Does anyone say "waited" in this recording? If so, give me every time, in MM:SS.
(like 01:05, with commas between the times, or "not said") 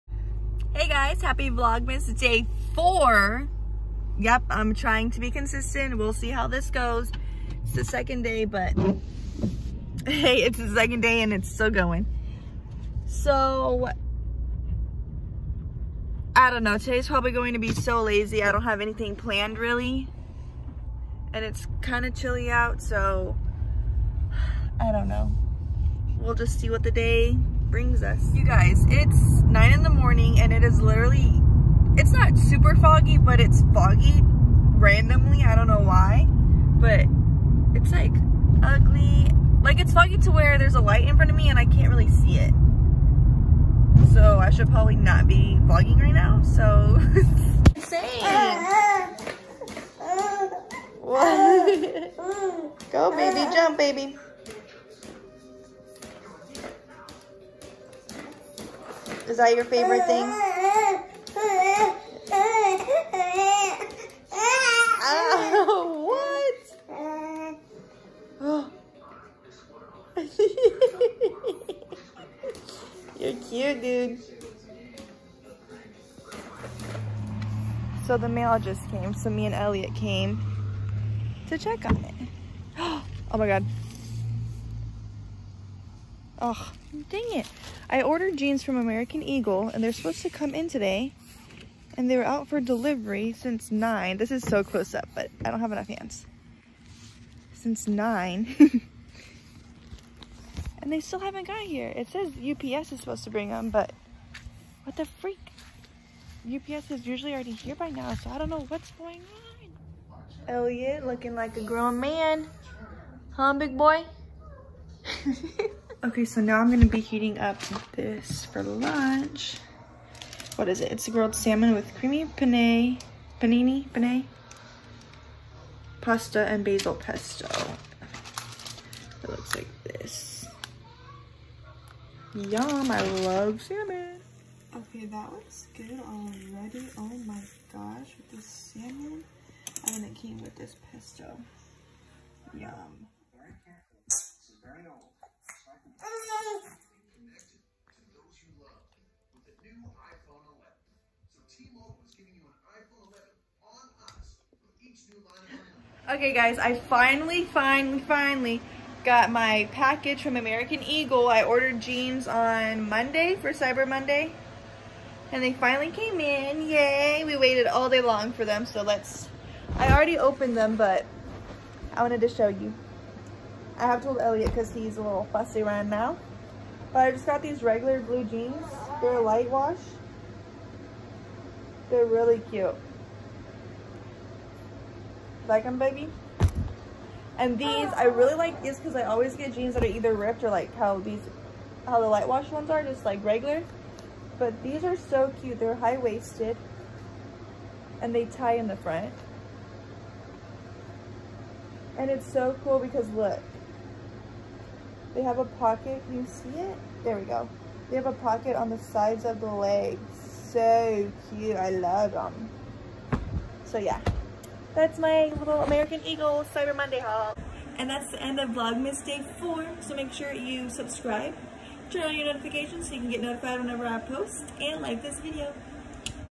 02:47.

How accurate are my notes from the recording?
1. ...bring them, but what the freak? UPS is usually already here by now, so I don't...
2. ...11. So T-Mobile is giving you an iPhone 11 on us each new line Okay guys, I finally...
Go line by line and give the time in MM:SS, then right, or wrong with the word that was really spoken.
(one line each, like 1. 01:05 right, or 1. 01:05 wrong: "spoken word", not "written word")
1. 01:43 right
2. 02:30 right.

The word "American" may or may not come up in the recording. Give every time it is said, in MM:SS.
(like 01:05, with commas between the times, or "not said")
01:28, 02:40, 03:35.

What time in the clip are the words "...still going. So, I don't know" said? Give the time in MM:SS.
00:11.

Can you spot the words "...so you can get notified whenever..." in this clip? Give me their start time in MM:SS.
03:42.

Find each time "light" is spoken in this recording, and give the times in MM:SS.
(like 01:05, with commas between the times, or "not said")
00:40, 02:59, 03:12.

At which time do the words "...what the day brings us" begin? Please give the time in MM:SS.
00:26.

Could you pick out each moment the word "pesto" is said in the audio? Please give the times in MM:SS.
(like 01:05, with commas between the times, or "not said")
02:06, 02:20.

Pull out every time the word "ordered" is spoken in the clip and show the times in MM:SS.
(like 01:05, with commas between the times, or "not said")
01:28, 02:41.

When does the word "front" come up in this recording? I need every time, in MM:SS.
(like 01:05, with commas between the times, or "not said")
00:41, 03:18.